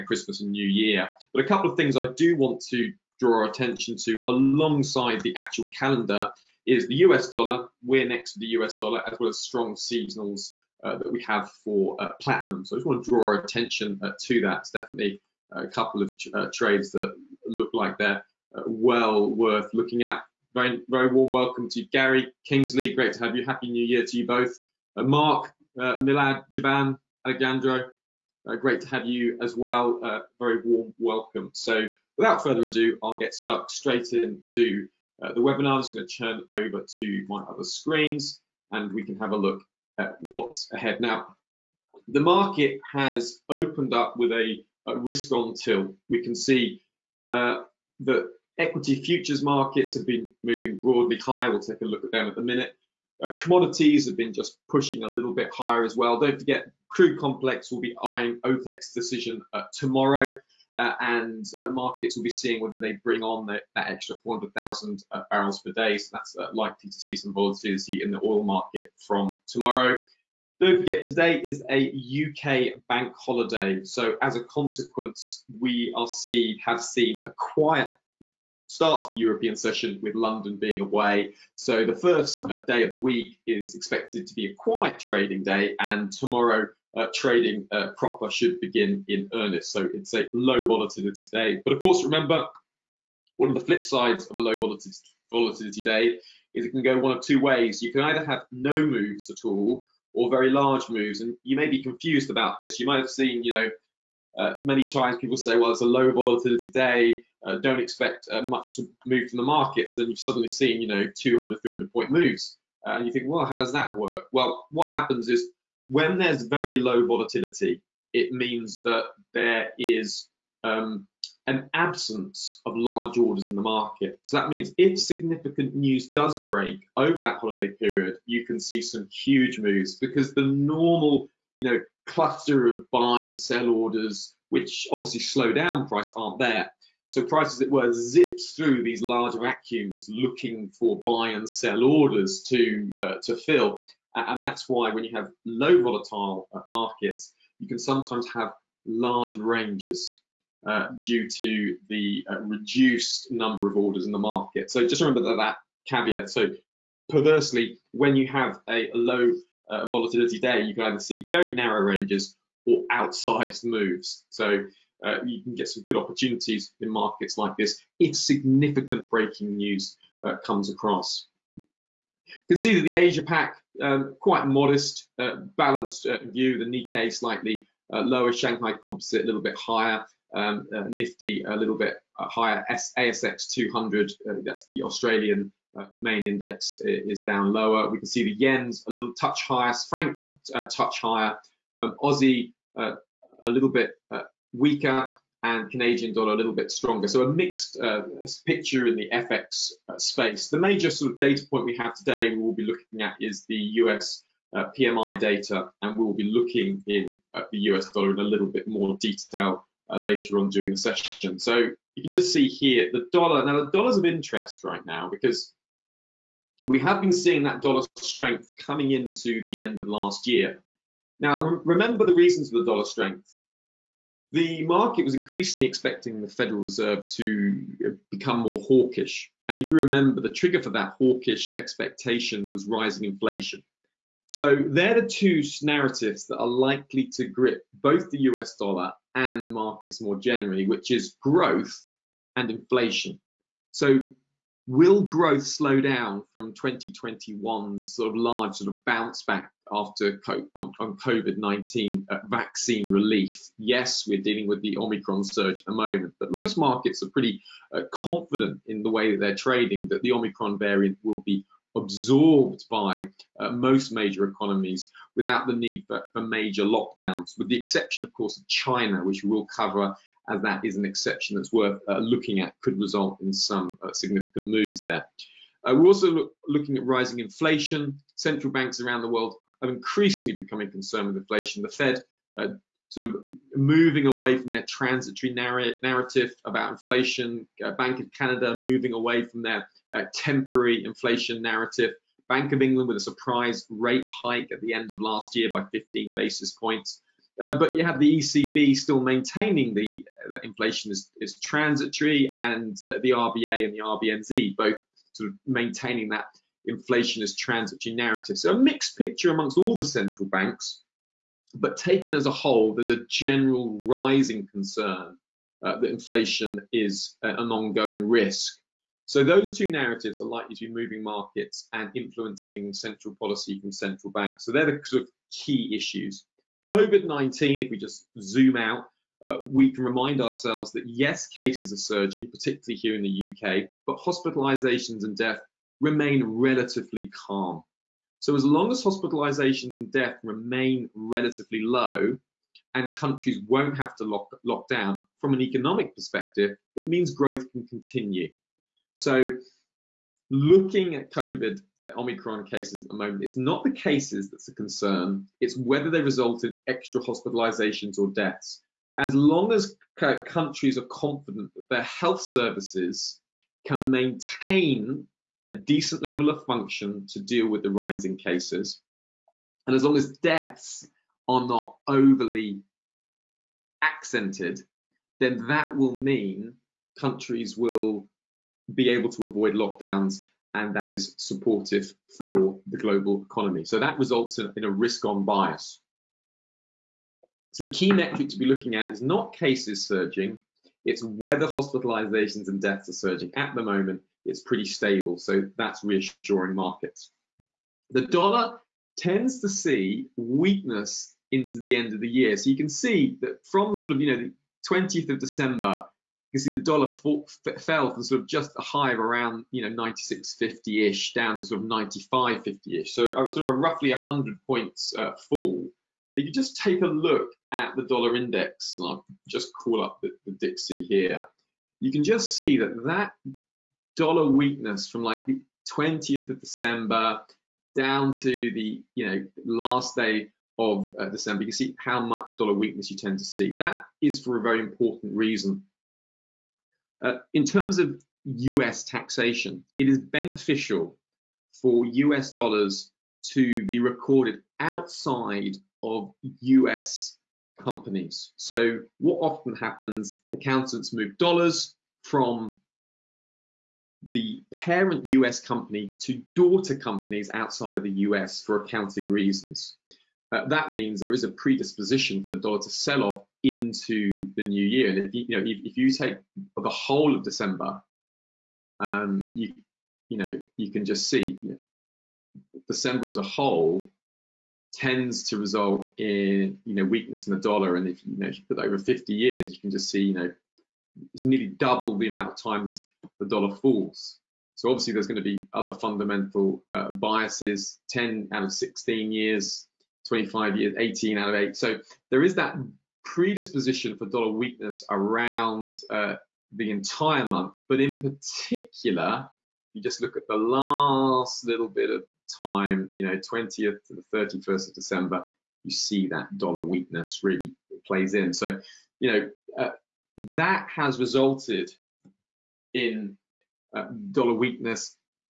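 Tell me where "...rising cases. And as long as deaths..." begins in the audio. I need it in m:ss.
6:07.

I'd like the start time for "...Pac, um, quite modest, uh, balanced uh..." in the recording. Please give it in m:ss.
2:53.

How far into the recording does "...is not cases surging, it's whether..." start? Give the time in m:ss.
6:28.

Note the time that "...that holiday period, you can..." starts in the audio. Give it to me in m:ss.
2:07.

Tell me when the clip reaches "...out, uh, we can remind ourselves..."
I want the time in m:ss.
5:28.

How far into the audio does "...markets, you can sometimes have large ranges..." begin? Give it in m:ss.
2:26.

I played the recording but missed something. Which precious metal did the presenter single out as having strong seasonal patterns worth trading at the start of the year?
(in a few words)
platinum.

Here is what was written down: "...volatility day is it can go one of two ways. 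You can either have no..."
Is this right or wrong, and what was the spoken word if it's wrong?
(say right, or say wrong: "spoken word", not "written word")
right.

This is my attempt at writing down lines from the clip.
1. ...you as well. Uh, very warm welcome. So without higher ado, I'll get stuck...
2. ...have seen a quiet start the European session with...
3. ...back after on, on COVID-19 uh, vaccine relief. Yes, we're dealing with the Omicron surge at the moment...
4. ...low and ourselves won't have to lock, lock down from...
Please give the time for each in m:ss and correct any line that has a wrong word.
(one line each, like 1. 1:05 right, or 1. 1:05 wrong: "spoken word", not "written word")
1. 0:29 wrong: "further", not "higher"
2. 1:16 right
3. 4:09 right
4. 5:41 wrong: "countries", not "ourselves".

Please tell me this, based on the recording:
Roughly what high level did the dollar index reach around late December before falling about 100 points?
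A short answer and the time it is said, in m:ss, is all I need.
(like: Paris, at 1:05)
96.50, at 6:49.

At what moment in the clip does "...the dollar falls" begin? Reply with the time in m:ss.
8:03.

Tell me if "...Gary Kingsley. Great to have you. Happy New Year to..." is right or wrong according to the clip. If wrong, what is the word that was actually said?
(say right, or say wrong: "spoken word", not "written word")
right.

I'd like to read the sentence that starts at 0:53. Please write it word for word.
Uh, commodities have been just pushing a little bit higher as well.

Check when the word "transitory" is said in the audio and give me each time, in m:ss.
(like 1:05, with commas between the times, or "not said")
4:44, 5:01, 5:07.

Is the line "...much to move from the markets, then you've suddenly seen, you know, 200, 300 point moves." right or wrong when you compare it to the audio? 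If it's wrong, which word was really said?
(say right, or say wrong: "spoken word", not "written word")
right.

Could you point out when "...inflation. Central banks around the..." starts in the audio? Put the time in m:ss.
4:37.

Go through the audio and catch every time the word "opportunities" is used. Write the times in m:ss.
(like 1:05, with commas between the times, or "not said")
2:45.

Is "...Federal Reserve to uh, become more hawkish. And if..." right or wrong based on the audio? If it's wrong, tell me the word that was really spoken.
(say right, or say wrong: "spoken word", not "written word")
right.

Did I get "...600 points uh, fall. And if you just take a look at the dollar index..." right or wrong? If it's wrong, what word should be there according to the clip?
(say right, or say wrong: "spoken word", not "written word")
wrong: "100", not "600".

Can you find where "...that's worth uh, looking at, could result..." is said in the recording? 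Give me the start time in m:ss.
4:31.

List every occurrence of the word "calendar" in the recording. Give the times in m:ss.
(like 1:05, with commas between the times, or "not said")
0:05.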